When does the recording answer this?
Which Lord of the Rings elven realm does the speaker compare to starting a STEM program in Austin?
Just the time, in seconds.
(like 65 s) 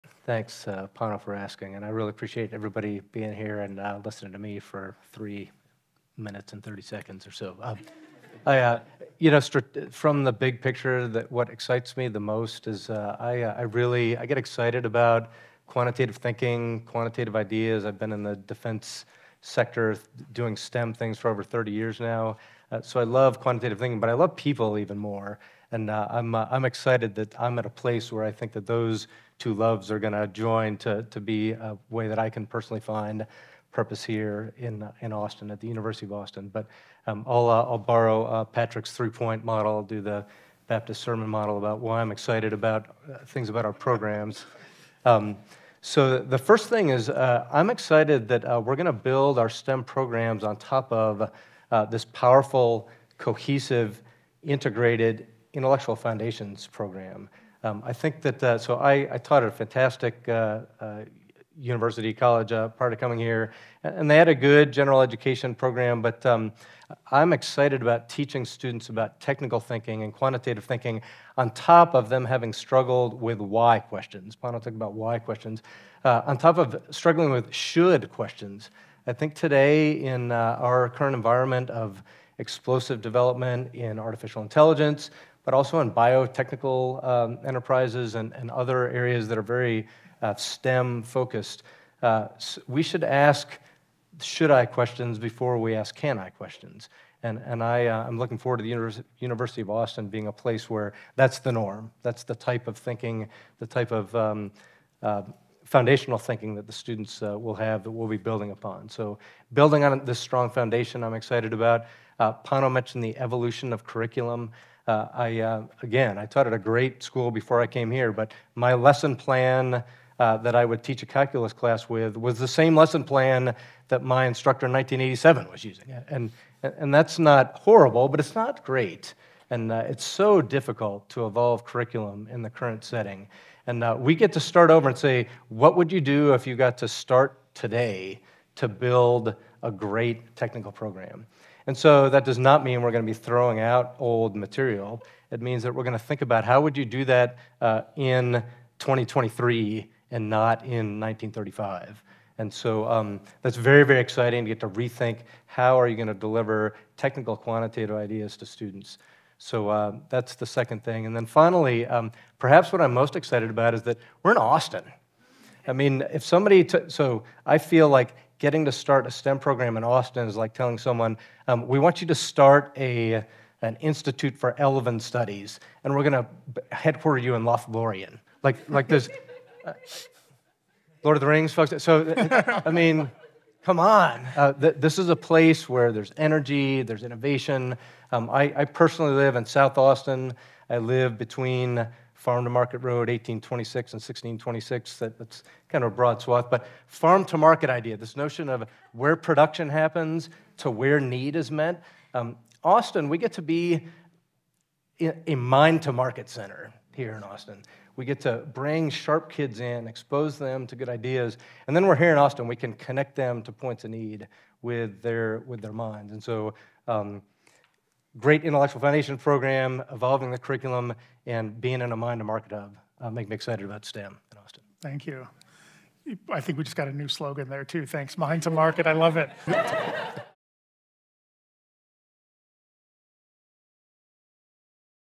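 177 s.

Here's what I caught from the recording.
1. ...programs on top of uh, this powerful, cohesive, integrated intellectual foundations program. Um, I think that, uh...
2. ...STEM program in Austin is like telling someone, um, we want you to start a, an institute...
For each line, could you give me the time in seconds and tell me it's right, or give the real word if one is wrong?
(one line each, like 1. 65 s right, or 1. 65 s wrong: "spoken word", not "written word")
1. 49 s right
2. 169 s right.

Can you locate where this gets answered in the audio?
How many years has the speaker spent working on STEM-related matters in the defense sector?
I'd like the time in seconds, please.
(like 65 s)
21 s.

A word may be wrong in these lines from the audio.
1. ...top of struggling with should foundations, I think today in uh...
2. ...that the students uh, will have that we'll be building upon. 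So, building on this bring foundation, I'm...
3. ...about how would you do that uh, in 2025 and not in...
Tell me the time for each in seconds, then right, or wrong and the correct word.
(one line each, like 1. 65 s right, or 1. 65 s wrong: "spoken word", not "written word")
1. 76 s wrong: "questions", not "foundations"
2. 106 s wrong: "strong", not "bring"
3. 146 s wrong: "2023", not "2025".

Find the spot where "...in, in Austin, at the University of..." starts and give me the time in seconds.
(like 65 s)
34 s.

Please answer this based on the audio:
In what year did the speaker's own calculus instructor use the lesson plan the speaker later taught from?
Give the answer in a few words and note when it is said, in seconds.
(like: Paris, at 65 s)
1987, at 124 s.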